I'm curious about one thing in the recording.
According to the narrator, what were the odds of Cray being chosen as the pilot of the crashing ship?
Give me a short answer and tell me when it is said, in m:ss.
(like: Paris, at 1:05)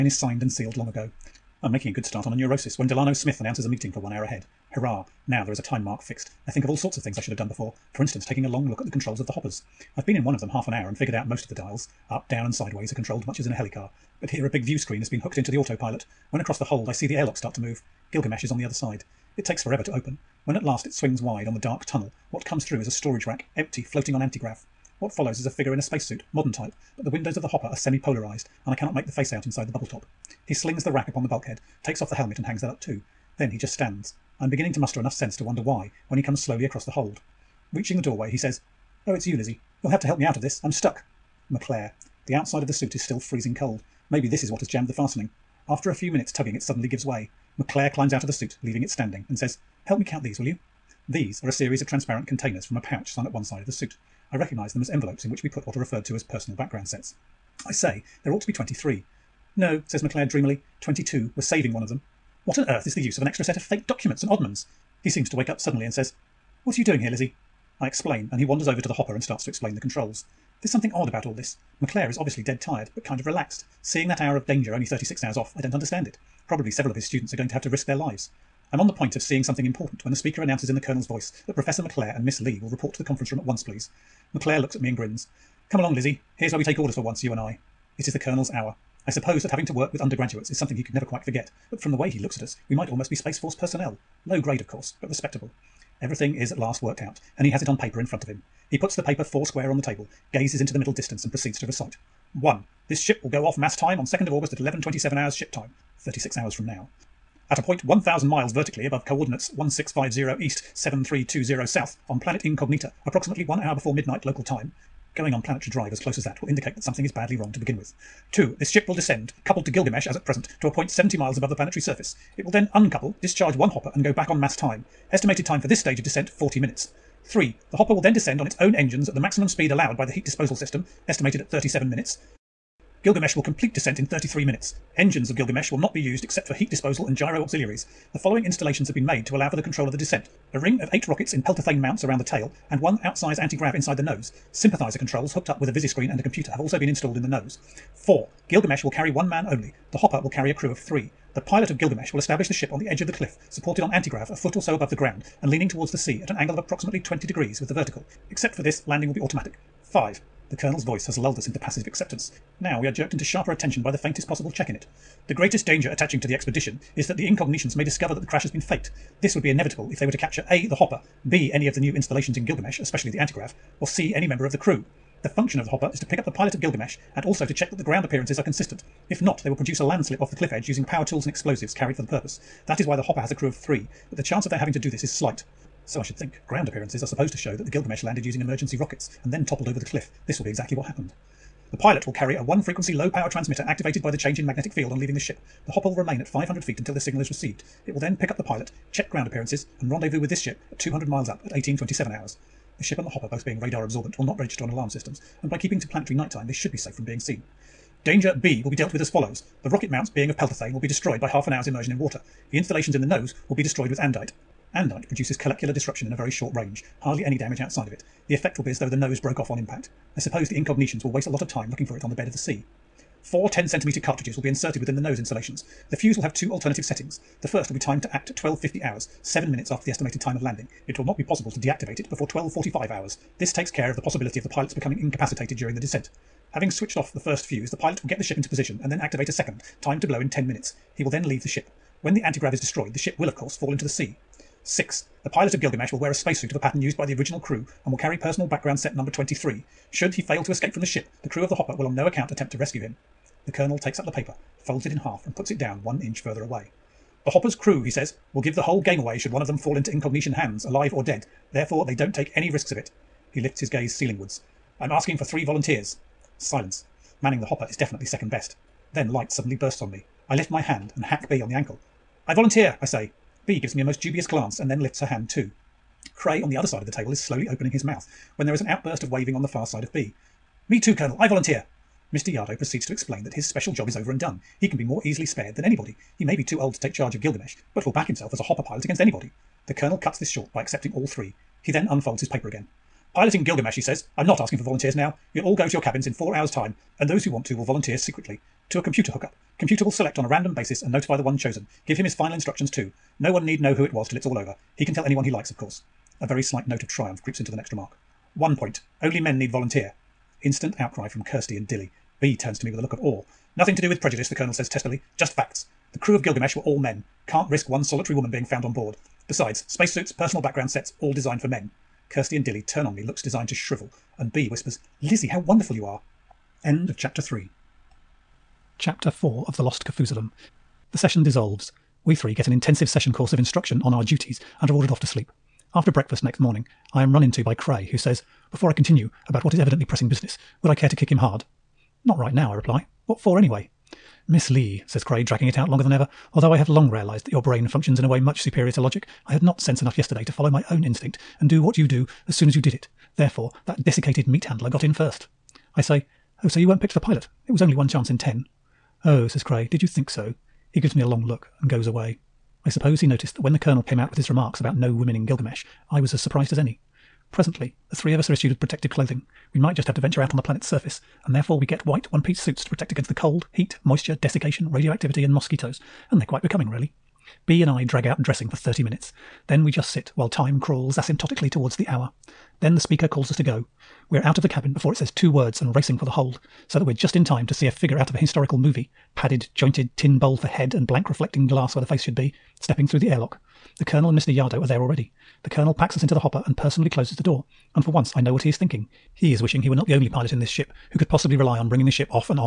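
1 in 10, at 5:57.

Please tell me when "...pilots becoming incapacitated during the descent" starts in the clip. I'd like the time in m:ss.
3:54.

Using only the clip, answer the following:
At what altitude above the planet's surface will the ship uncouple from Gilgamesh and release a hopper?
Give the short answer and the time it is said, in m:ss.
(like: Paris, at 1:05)
70 miles, at 2:00.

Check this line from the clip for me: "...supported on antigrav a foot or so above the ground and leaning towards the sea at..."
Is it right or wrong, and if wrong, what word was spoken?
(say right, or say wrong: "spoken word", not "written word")
right.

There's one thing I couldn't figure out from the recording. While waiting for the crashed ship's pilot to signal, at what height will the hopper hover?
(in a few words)
500 feet.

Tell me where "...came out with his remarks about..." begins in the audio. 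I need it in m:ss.
6:03.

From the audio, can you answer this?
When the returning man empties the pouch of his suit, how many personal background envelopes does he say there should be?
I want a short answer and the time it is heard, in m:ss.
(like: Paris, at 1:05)
22, at 1:00.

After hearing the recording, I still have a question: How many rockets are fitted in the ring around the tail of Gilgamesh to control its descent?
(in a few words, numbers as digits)
8.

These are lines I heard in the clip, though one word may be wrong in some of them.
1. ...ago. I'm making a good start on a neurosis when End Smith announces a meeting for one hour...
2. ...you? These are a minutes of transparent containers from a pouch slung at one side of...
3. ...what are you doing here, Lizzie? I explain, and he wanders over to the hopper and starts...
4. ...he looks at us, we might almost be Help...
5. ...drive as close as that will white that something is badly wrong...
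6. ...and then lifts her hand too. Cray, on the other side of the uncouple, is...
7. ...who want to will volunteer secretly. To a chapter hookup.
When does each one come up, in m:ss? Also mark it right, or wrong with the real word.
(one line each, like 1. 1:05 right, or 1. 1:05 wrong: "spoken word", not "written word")
1. 0:00 wrong: "Delano", not "End"
2. 0:50 wrong: "series", not "minutes"
3. 1:06 right
4. 1:32 wrong: "Space", not "Help"
5. 1:55 wrong: "indicate", not "white"
6. 4:34 wrong: "table", not "uncouple"
7. 4:57 wrong: "computer", not "chapter".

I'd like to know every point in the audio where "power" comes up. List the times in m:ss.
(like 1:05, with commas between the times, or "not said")
3:00, 3:13.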